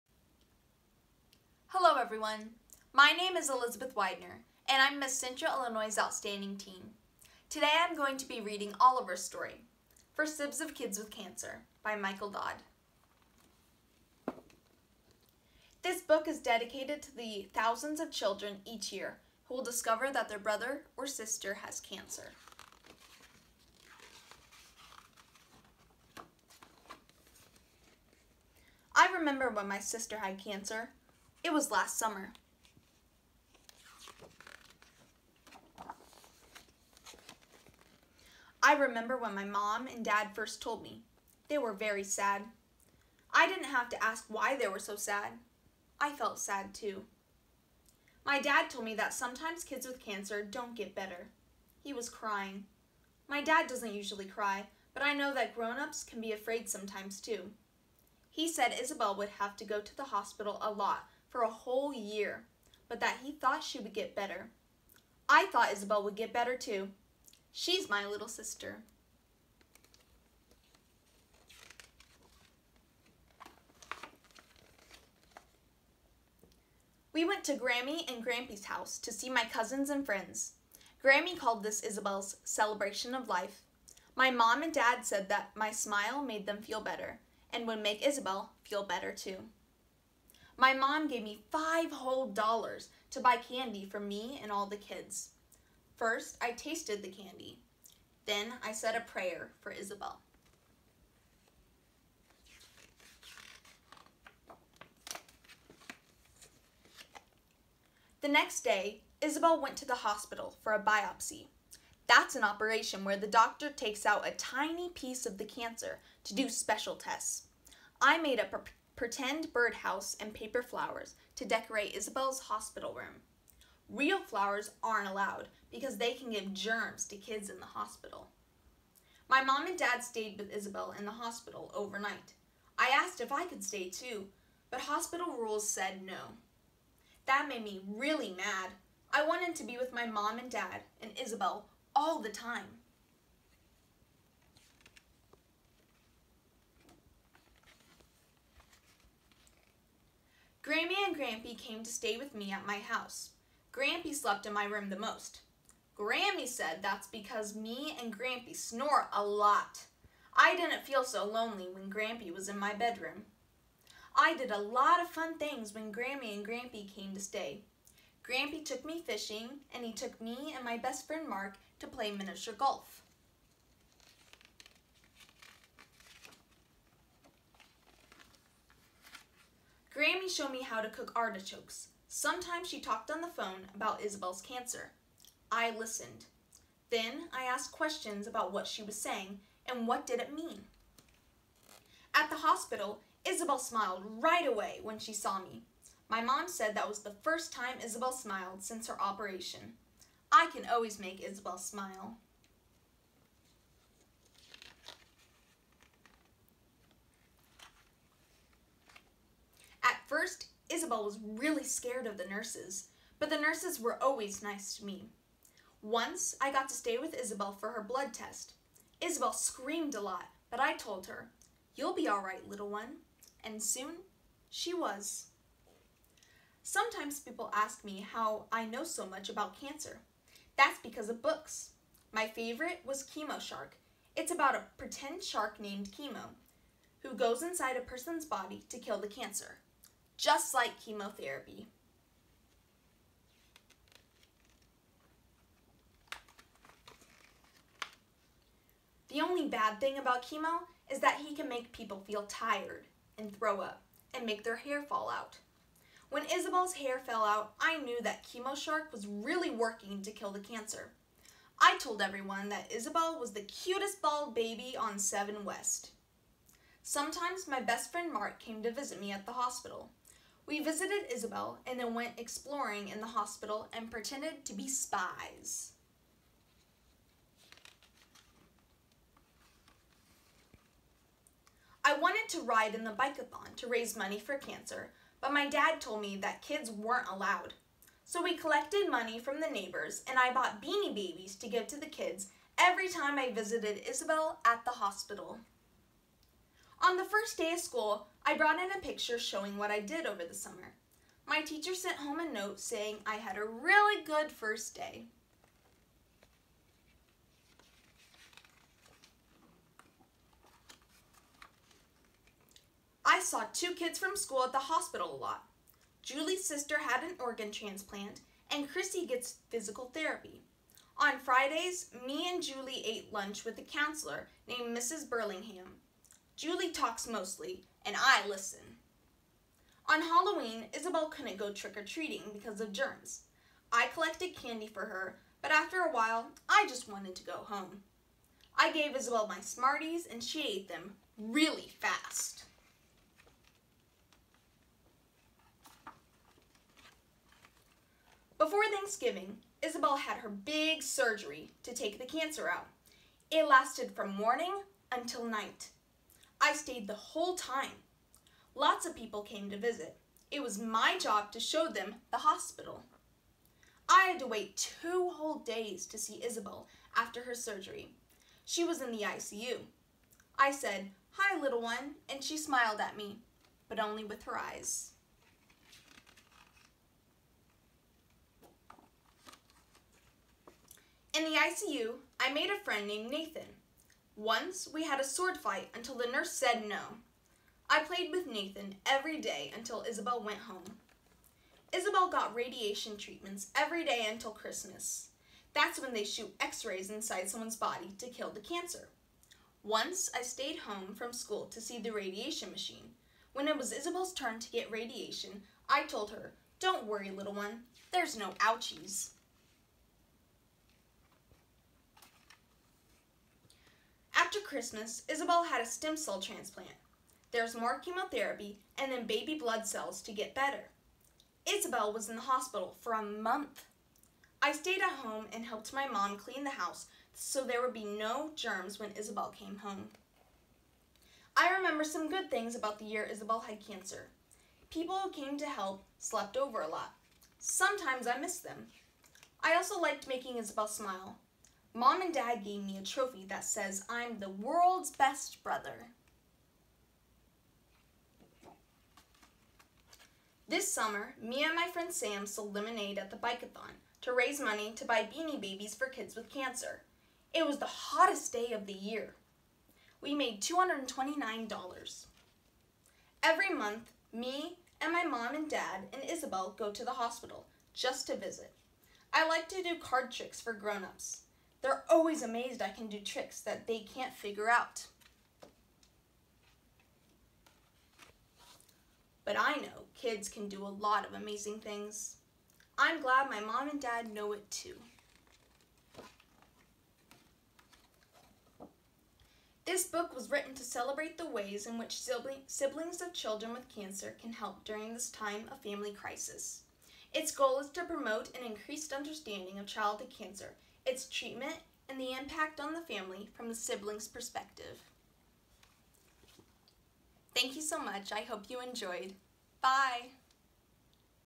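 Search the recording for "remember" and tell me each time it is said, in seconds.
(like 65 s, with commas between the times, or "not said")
29 s, 38 s, 431 s.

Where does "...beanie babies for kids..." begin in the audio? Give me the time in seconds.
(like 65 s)
455 s.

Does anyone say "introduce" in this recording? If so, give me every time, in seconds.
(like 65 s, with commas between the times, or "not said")
not said.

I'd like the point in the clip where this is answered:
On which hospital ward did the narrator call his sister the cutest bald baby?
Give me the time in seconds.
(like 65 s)
264 s.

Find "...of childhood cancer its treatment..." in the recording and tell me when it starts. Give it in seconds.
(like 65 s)
499 s.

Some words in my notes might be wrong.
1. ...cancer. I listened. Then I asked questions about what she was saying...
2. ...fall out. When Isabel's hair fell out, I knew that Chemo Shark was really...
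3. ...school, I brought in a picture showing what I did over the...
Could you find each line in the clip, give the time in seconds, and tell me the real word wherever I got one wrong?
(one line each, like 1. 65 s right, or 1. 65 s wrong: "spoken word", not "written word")
1. 184 s right
2. 254 s right
3. 297 s right.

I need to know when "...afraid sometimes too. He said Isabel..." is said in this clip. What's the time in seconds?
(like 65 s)
56 s.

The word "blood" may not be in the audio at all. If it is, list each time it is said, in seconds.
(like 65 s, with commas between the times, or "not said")
217 s, 419 s.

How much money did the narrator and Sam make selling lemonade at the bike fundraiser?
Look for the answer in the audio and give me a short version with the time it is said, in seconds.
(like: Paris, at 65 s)
$229, at 460 s.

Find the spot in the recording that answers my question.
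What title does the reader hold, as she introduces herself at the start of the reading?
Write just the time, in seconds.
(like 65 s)
4 s.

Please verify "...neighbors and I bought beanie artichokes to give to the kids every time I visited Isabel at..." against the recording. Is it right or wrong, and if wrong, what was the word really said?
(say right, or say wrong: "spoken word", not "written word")
wrong: "babies", not "artichokes".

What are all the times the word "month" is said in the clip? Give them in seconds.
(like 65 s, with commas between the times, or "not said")
423 s, 463 s.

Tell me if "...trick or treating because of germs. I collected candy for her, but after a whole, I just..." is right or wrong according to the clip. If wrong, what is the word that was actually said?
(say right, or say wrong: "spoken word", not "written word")
wrong: "while", not "whole".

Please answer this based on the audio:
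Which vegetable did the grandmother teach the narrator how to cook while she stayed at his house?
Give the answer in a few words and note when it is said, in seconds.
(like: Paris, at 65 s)
Artichokes, at 181 s.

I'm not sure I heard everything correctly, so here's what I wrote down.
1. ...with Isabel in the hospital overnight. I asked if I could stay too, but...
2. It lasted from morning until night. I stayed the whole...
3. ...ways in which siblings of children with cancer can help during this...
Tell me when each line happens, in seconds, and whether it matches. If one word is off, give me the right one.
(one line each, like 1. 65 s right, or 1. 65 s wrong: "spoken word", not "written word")
1. 130 s right
2. 353 s right
3. 491 s right.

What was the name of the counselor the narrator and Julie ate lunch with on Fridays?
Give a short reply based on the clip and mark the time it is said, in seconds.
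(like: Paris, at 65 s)
Mrs. Burlingham, at 324 s.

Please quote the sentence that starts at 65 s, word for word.
I thought Isabel would get better too.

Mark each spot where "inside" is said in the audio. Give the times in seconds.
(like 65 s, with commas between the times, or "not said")
237 s, 396 s.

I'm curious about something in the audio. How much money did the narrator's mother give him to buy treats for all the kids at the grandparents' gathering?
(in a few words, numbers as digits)
$5.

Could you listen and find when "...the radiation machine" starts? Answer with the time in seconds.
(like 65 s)
401 s.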